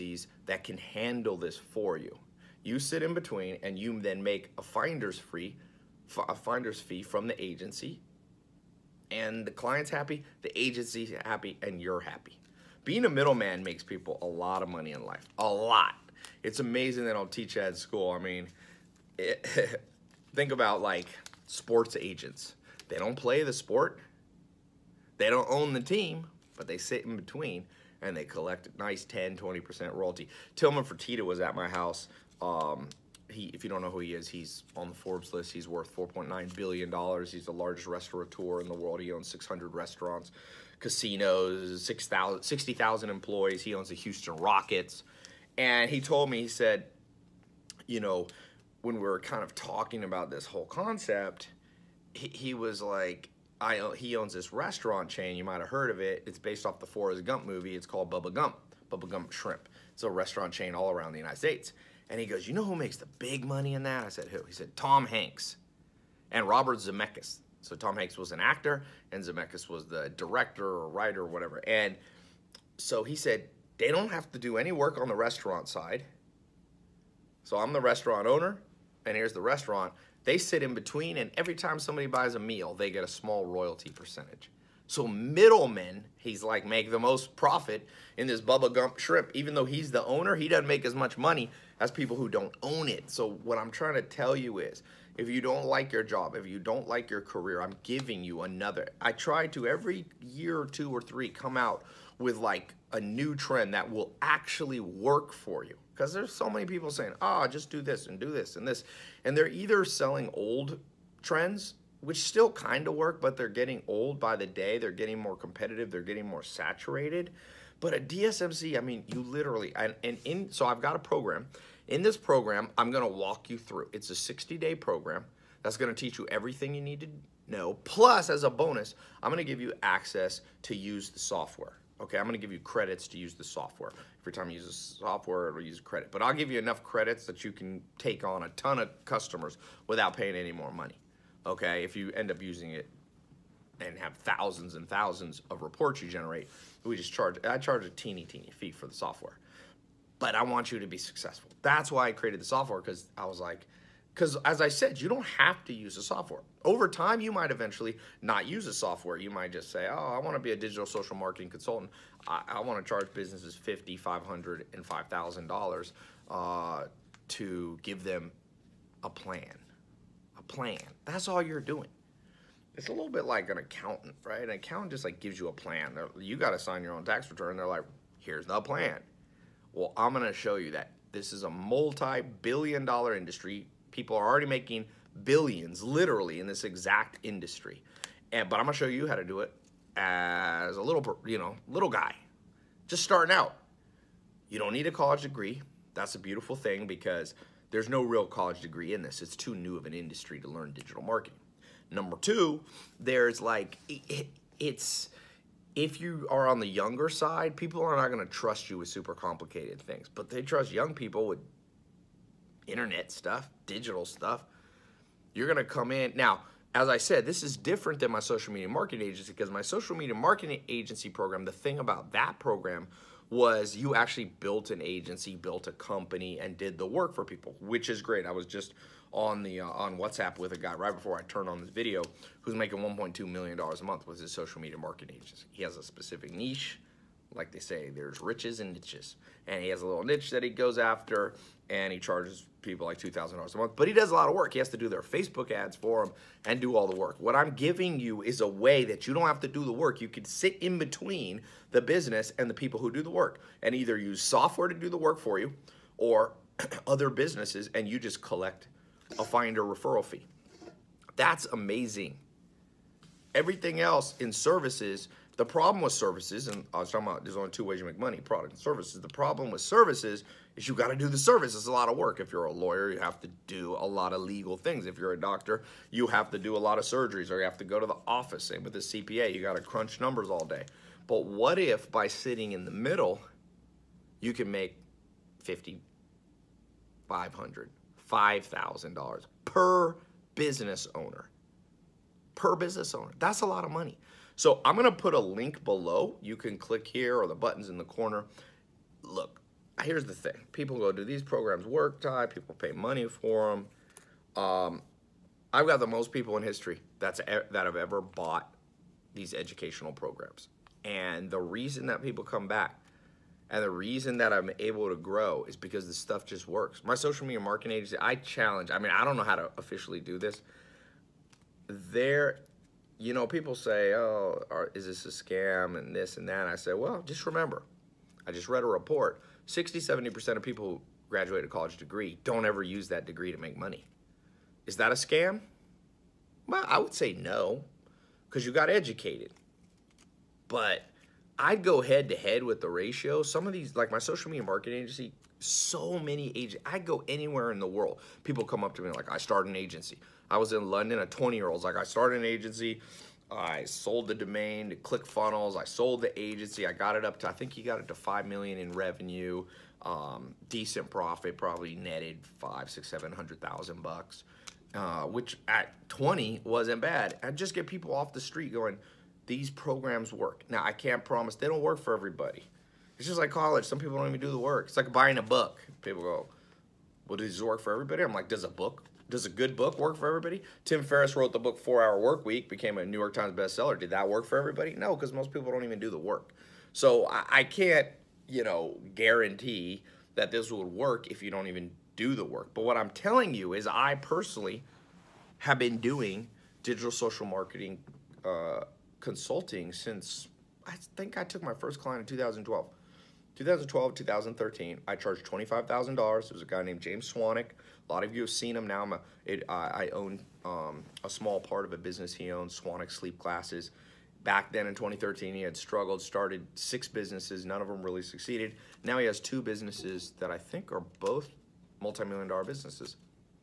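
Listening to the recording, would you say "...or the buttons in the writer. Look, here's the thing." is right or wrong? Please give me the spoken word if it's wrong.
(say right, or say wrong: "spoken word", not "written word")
wrong: "corner", not "writer".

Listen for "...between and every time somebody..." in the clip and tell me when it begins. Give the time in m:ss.
1:20.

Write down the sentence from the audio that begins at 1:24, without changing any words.
So middlemen, he's like, make the most profit in this Bubba Gump shrimp.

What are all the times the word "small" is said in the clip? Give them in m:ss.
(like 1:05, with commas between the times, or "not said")
1:23, 6:51.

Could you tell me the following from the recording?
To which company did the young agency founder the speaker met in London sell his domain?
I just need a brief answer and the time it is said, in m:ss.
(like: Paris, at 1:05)
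ClickFunnels, at 5:54.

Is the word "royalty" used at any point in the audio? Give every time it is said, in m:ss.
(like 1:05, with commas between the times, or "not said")
0:29, 1:23.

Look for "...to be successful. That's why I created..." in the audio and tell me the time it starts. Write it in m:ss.
2:30.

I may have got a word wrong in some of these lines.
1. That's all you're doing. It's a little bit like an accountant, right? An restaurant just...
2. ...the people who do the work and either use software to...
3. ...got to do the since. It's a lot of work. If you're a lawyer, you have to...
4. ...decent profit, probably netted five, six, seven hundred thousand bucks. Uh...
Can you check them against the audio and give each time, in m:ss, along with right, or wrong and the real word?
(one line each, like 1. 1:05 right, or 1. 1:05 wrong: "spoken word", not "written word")
1. 2:51 wrong: "accountant", not "restaurant"
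2. 4:12 right
3. 4:30 wrong: "service", not "since"
4. 6:00 right.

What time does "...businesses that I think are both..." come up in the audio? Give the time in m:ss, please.
6:59.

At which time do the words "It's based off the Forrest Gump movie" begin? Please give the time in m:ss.
0:56.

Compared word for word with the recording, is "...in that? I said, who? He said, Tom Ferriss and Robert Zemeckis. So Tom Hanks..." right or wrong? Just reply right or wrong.
wrong.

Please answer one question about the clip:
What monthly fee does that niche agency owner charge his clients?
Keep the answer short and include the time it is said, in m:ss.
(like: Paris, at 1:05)
$2,000, at 4:02.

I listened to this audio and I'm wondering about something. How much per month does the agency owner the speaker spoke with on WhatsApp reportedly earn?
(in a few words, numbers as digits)
$1.2 million.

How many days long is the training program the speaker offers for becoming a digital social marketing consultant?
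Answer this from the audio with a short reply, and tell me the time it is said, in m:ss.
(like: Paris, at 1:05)
60, at 2:04.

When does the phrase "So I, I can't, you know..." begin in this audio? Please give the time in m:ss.
6:26.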